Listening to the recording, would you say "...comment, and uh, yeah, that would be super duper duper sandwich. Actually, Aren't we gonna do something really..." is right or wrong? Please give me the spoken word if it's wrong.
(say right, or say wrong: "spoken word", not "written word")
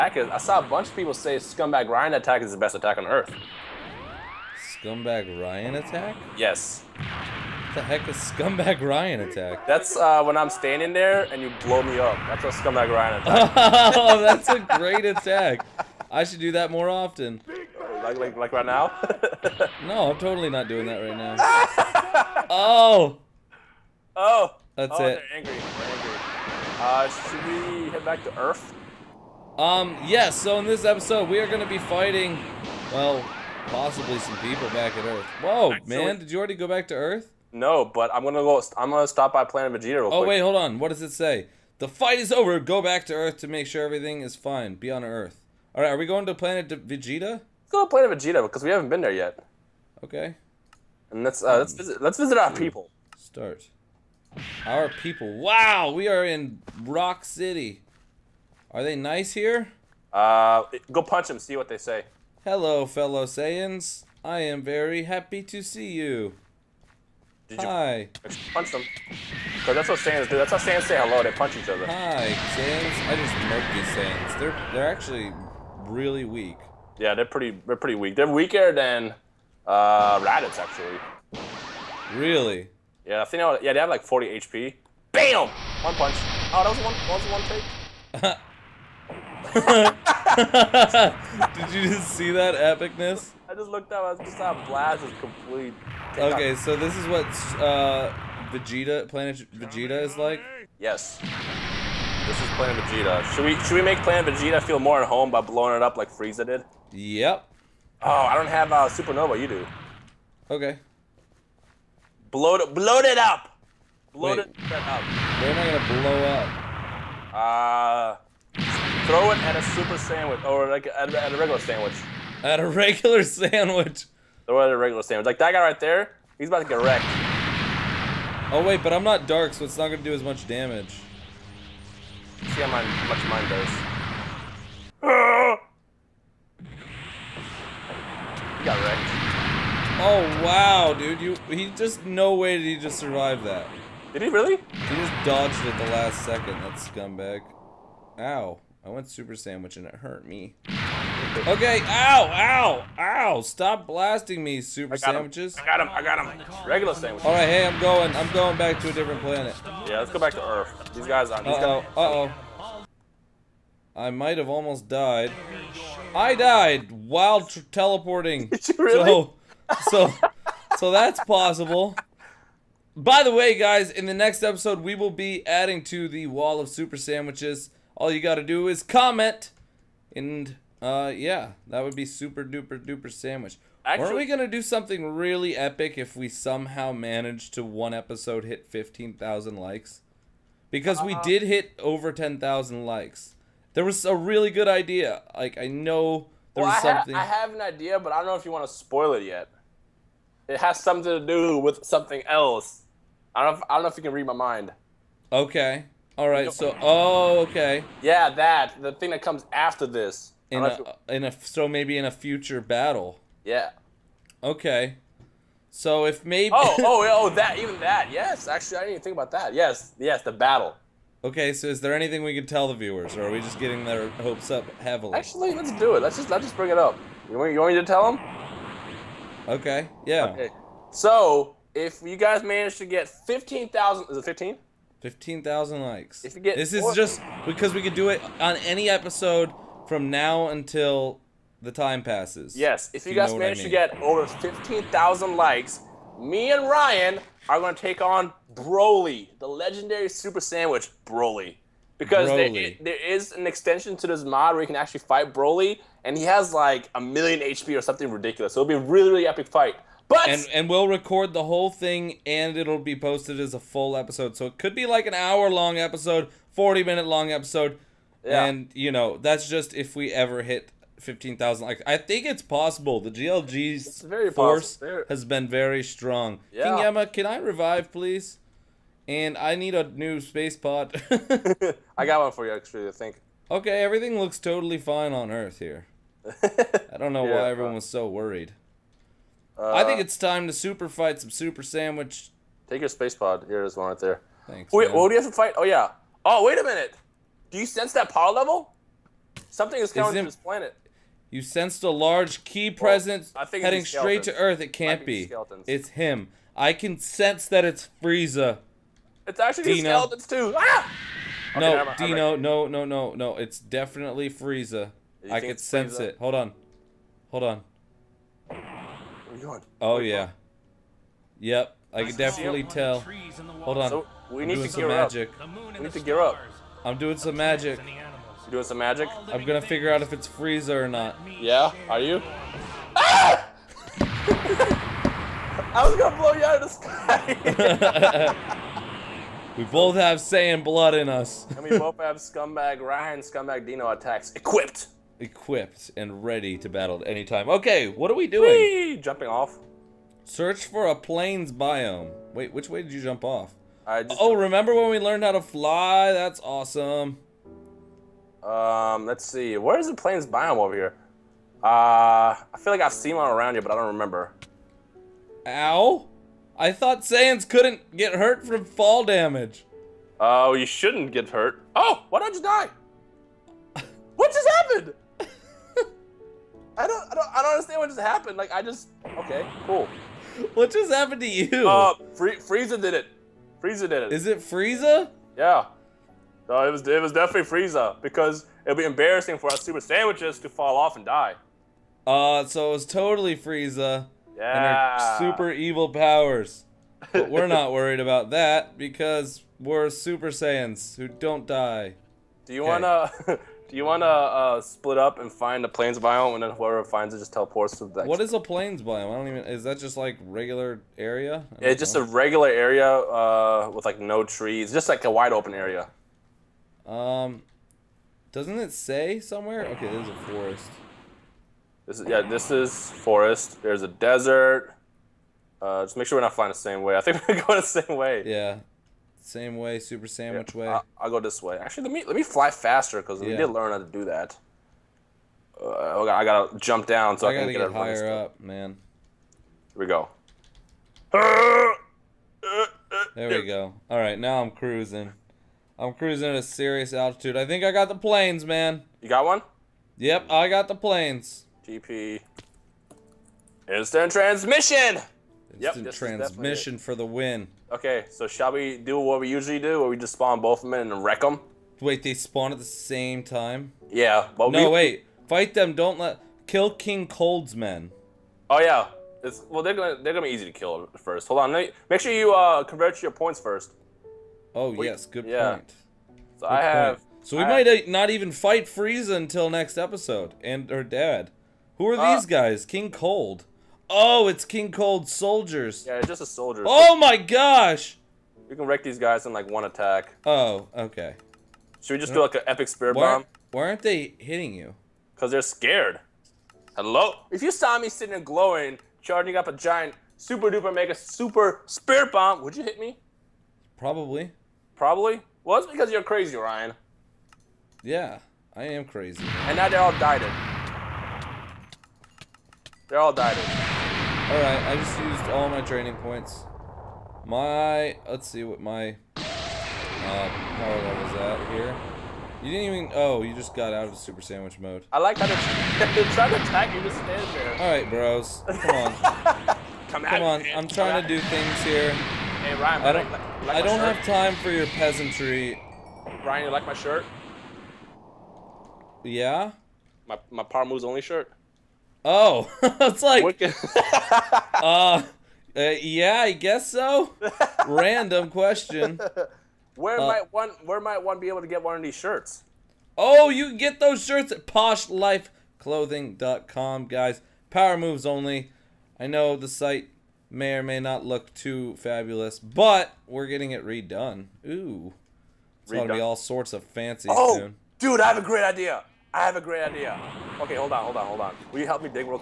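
right.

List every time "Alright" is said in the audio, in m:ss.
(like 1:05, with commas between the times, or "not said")
8:34, 8:47.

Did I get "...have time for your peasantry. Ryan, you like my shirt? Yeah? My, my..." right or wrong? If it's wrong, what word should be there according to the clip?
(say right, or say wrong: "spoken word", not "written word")
right.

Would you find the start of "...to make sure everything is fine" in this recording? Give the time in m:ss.
0:43.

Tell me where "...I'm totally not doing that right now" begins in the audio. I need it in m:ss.
0:20.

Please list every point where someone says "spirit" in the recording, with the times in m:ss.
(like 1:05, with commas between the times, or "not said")
8:12, 8:21.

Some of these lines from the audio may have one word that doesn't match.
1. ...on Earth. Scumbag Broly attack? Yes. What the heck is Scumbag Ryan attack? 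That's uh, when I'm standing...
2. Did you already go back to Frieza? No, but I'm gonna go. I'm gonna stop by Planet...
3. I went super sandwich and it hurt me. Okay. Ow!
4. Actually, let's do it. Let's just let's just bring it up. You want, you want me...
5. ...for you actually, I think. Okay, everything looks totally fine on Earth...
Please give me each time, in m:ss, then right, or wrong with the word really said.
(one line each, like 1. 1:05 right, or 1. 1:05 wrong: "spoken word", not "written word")
1. 0:02 wrong: "Ryan", not "Broly"
2. 0:36 wrong: "Earth", not "Frieza"
3. 2:28 right
4. 3:45 right
5. 4:42 right.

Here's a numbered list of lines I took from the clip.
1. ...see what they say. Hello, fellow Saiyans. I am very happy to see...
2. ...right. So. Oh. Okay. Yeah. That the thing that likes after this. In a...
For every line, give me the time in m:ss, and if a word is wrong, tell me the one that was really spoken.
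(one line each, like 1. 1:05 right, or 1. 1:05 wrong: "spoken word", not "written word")
1. 1:01 right
2. 3:26 wrong: "comes", not "likes".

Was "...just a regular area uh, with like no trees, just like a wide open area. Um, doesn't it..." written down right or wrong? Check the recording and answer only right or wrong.
right.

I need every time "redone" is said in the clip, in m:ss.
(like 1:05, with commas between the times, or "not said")
9:23.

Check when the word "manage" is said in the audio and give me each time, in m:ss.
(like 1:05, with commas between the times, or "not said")
3:06, 3:52, 4:03.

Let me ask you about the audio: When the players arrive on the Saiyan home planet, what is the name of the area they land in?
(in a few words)
Rock City.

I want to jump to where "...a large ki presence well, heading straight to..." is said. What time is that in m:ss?
5:01.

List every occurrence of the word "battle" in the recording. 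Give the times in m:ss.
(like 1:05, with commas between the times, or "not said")
3:32, 3:40, 5:46.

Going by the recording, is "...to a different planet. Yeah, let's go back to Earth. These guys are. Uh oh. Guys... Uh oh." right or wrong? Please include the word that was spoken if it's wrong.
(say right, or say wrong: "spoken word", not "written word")
right.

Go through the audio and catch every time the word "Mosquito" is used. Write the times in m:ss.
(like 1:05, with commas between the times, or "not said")
not said.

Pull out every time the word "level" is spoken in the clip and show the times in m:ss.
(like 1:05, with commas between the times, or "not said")
4:58, 8:40.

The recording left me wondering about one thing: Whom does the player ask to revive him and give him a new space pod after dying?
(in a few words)
King Yama.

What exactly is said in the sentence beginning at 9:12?
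Oh, you can get those shirts at poshlifeclothing.com, guys.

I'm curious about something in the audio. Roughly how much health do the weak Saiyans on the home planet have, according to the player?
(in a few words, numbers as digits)
40 HP.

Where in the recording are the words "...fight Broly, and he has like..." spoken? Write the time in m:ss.
4:14.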